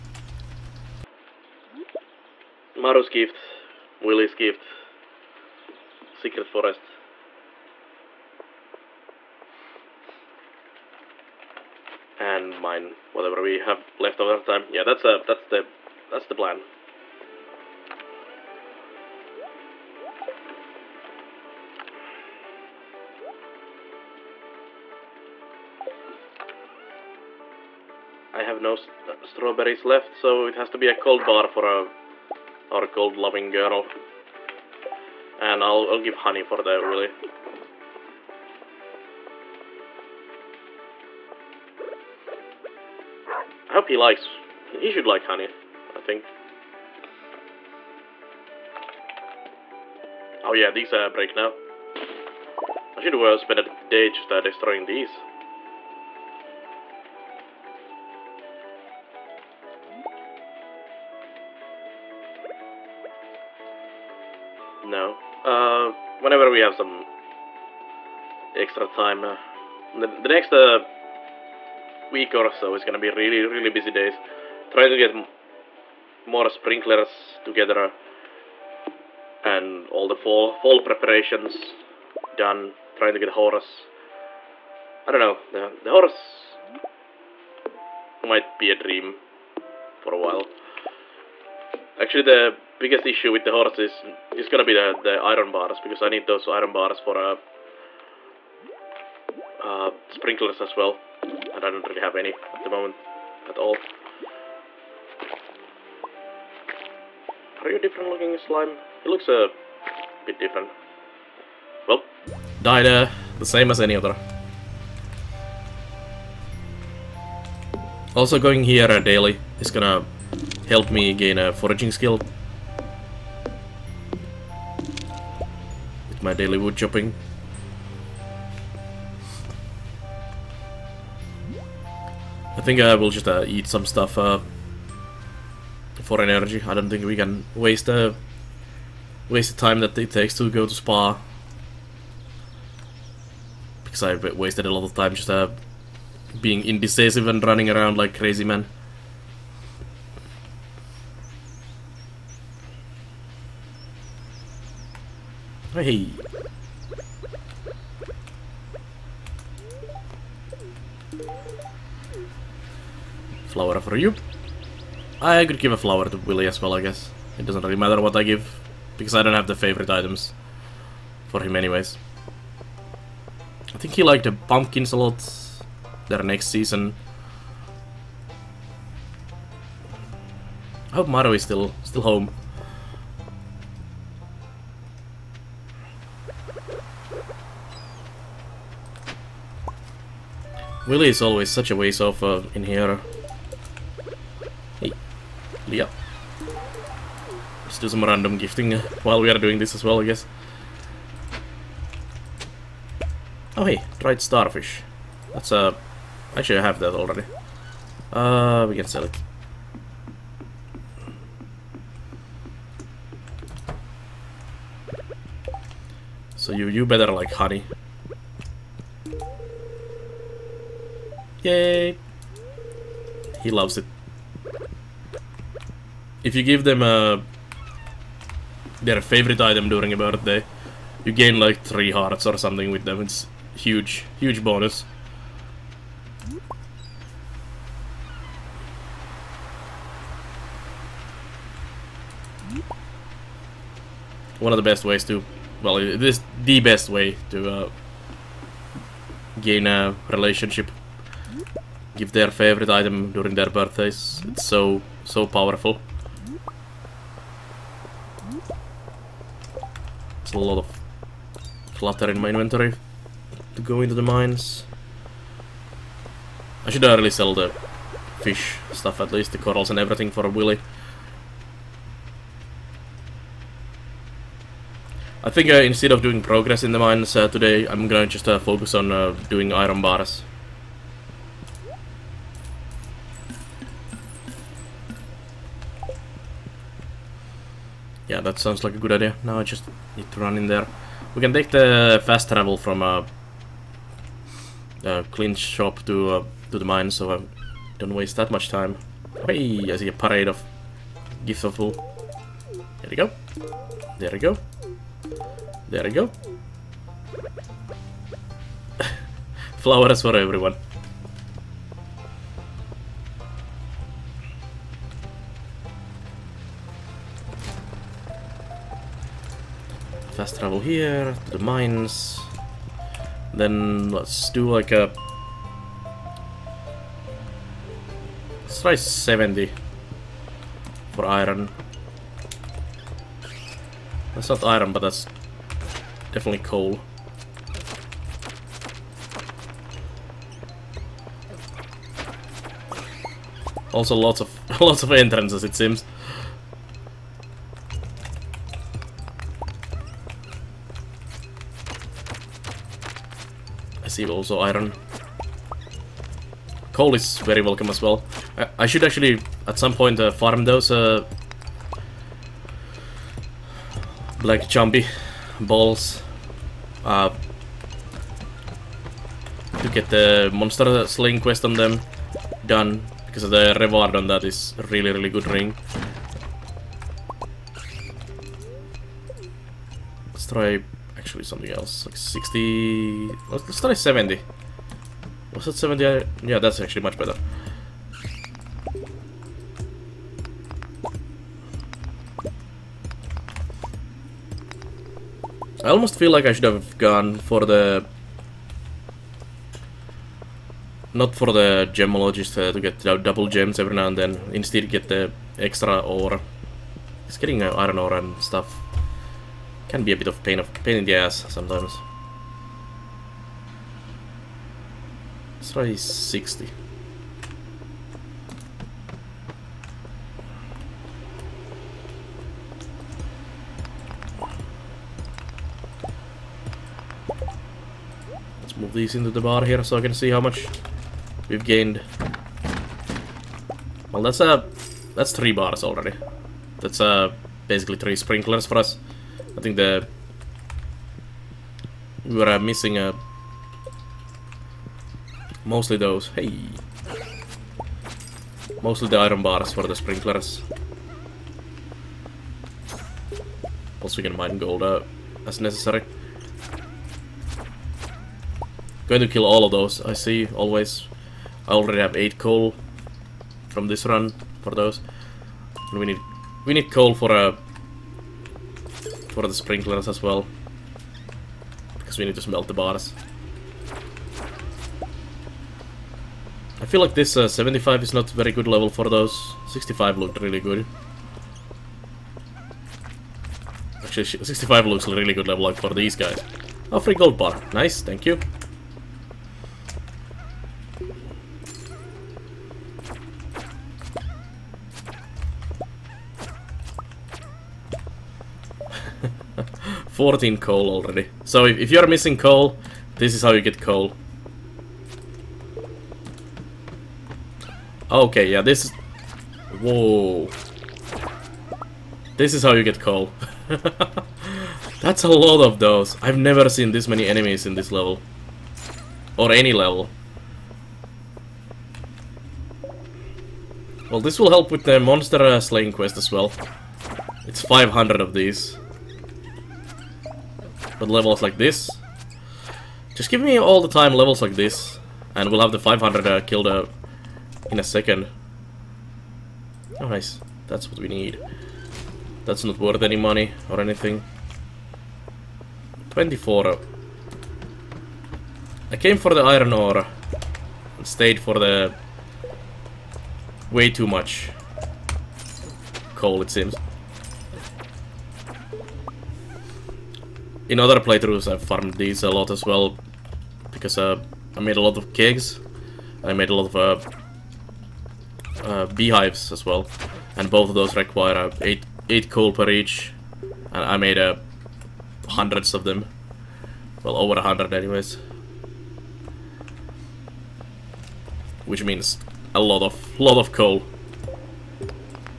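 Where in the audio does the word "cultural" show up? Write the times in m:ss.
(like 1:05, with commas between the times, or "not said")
not said.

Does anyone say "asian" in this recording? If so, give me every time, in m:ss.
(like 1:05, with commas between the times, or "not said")
not said.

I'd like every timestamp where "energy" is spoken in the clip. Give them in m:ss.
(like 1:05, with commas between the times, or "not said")
2:16.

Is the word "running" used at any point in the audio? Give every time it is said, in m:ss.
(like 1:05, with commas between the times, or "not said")
2:27.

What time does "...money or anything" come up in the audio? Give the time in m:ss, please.
9:02.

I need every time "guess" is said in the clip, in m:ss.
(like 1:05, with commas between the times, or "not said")
2:46, 3:20.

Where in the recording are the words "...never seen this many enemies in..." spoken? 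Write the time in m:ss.
8:36.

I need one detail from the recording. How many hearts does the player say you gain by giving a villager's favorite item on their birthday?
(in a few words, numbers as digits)
3.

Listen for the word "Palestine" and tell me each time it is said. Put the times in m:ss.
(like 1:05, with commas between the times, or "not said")
not said.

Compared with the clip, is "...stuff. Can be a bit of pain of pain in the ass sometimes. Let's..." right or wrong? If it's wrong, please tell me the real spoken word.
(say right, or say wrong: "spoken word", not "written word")
right.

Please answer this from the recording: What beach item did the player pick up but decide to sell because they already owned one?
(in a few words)
Dried starfish.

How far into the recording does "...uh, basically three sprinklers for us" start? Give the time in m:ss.
7:16.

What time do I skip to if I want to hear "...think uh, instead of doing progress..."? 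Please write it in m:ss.
4:35.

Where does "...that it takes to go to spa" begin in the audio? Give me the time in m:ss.
2:19.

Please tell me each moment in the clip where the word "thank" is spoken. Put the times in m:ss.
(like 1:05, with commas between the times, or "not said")
8:07.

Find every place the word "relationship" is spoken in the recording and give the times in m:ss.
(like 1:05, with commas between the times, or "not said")
4:10.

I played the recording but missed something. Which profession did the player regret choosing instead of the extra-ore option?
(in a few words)
Gemologist.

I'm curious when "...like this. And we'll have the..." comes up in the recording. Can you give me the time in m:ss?
8:54.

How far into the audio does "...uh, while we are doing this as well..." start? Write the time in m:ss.
3:18.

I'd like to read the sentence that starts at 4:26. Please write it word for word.
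I should really sell the fish stuff at least, the corals and everything for a Willy.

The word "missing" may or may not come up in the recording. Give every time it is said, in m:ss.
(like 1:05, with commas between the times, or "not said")
7:22, 8:21.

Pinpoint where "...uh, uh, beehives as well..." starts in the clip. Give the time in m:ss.
9:26.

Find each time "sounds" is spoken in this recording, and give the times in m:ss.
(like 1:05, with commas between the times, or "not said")
4:48.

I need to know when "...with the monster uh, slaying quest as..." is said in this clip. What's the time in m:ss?
8:44.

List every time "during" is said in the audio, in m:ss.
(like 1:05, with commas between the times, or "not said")
3:49, 4:13.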